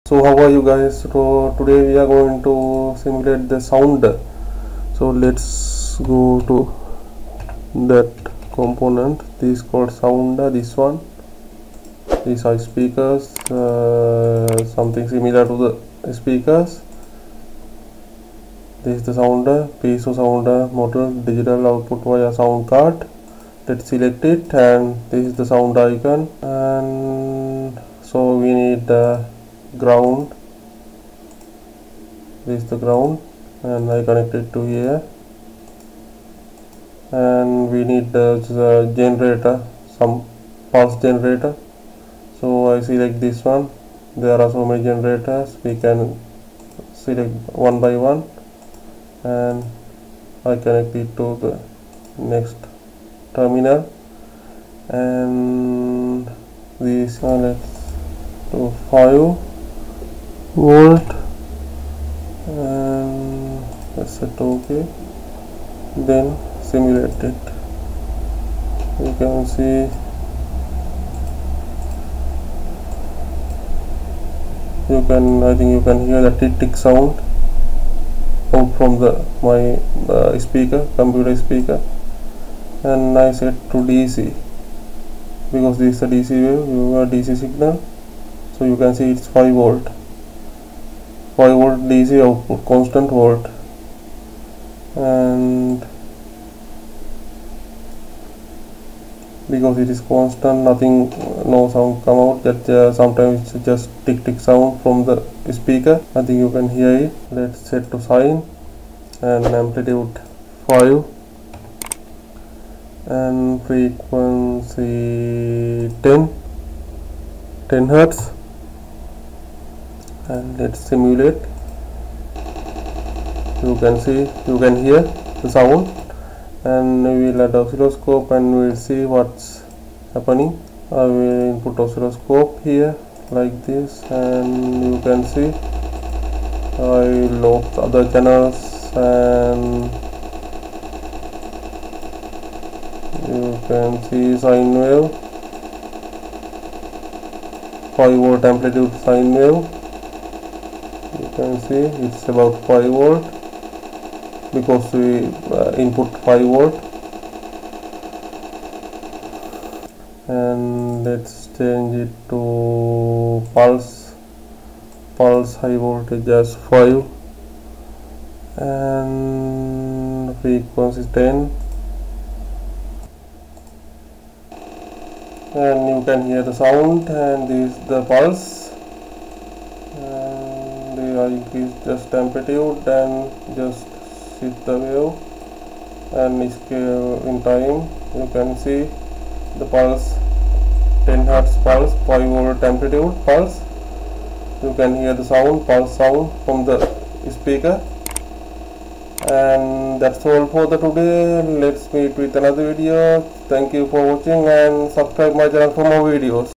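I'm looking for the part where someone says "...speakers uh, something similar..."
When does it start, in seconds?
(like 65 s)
12 s.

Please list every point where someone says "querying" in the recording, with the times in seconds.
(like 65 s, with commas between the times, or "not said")
not said.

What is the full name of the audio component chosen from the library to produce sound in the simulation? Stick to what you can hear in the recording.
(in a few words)
piezo sounder.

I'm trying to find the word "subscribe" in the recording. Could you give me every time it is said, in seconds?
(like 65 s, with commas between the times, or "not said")
204 s.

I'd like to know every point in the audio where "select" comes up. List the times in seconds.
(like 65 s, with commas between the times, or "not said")
23 s, 42 s, 46 s.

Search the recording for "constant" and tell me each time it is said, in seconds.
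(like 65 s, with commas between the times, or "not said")
92 s, 100 s.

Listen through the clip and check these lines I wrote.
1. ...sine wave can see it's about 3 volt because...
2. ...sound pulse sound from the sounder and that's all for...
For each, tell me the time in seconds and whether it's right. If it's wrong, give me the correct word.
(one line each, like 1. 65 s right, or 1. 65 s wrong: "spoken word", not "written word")
1. 149 s wrong: "5", not "3"
2. 195 s wrong: "speaker", not "sounder".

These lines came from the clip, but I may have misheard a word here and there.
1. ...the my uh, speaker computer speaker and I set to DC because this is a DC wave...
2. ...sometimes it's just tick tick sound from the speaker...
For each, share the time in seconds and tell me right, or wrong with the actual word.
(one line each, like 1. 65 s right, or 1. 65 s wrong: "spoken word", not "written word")
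1. 78 s right
2. 102 s right.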